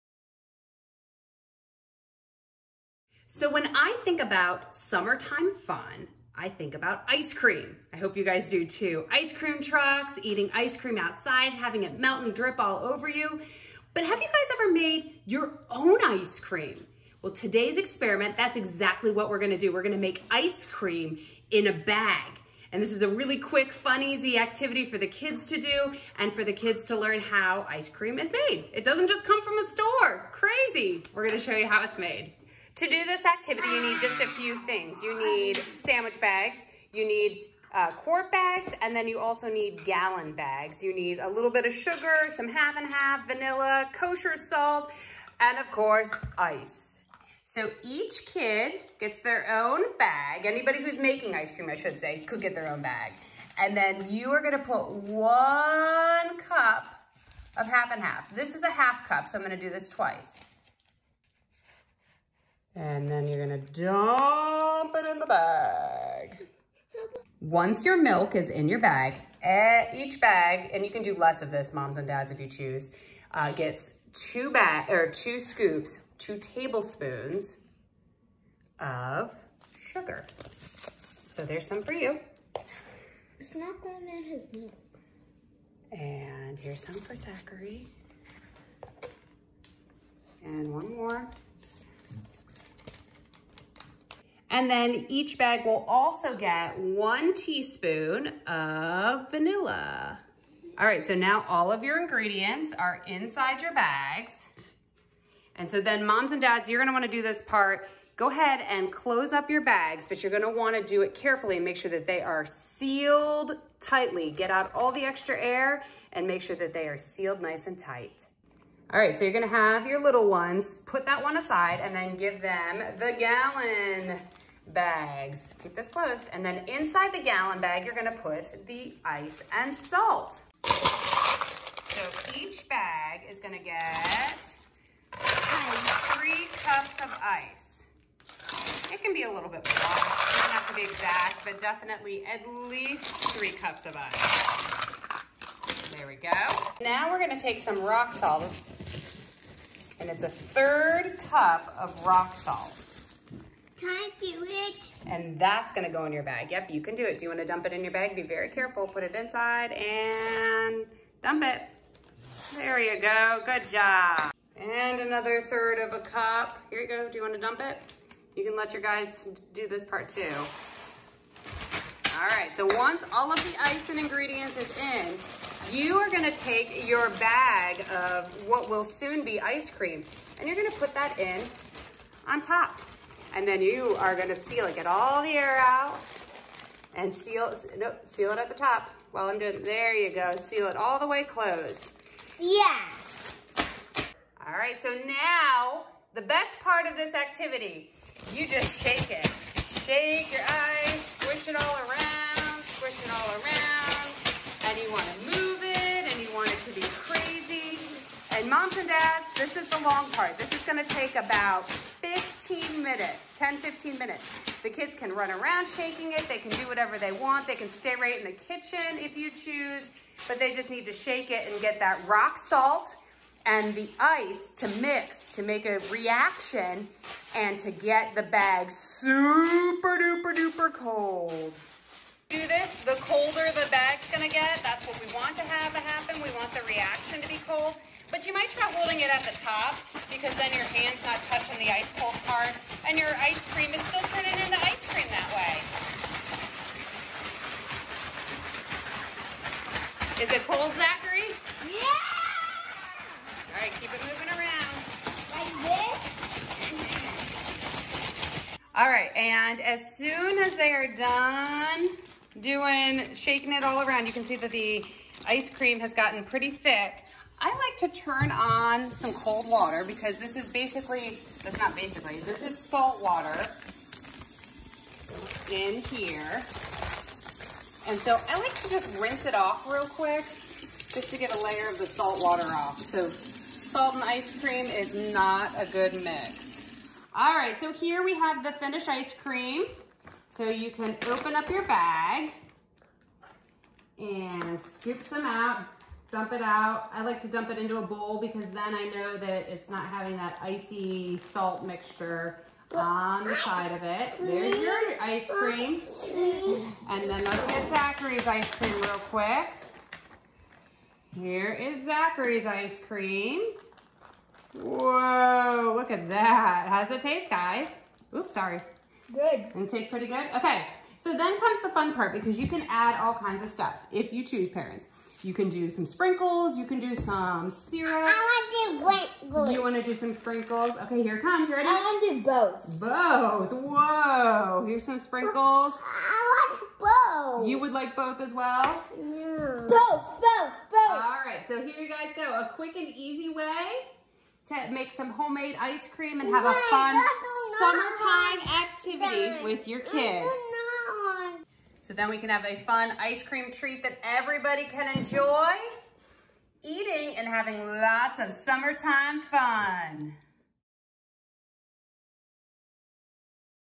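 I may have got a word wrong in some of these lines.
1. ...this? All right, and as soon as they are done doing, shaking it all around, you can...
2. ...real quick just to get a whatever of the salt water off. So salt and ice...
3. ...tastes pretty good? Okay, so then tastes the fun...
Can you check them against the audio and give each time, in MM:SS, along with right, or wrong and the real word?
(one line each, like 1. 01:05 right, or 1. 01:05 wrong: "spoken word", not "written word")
1. 04:15 right
2. 04:39 wrong: "layer", not "whatever"
3. 05:19 wrong: "comes", not "tastes".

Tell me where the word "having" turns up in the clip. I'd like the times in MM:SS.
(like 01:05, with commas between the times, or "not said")
00:11, 04:59, 05:57.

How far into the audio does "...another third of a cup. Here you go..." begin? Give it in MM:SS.
02:45.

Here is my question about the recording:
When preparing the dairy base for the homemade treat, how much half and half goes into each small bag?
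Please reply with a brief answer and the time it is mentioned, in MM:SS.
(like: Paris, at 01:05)
1 cup, at 00:54.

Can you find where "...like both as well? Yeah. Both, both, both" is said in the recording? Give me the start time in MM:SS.
05:37.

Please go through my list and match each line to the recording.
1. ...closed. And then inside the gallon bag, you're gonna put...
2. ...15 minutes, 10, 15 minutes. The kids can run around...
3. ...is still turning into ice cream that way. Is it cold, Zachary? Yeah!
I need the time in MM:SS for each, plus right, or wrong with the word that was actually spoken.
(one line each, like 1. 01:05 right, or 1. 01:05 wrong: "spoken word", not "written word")
1. 02:05 right
2. 03:32 right
3. 04:03 right.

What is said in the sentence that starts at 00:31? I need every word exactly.
We're gonna show you how it's made.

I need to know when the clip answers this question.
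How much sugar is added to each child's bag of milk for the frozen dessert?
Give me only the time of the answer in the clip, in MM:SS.
01:16.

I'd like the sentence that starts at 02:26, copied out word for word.
Now we're gonna take some rock salt, and it's a third cup of rock salt.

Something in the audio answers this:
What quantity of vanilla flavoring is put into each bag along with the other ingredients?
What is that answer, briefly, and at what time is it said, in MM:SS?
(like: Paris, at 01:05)
1 teaspoon, at 01:36.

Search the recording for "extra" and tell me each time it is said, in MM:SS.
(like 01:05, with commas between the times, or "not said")
01:55.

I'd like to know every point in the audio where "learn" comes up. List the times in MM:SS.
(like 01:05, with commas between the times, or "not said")
00:26.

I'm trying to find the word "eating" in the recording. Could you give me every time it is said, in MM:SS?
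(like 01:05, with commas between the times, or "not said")
00:10, 05:56.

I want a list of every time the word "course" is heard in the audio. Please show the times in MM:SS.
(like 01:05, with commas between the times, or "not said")
00:45.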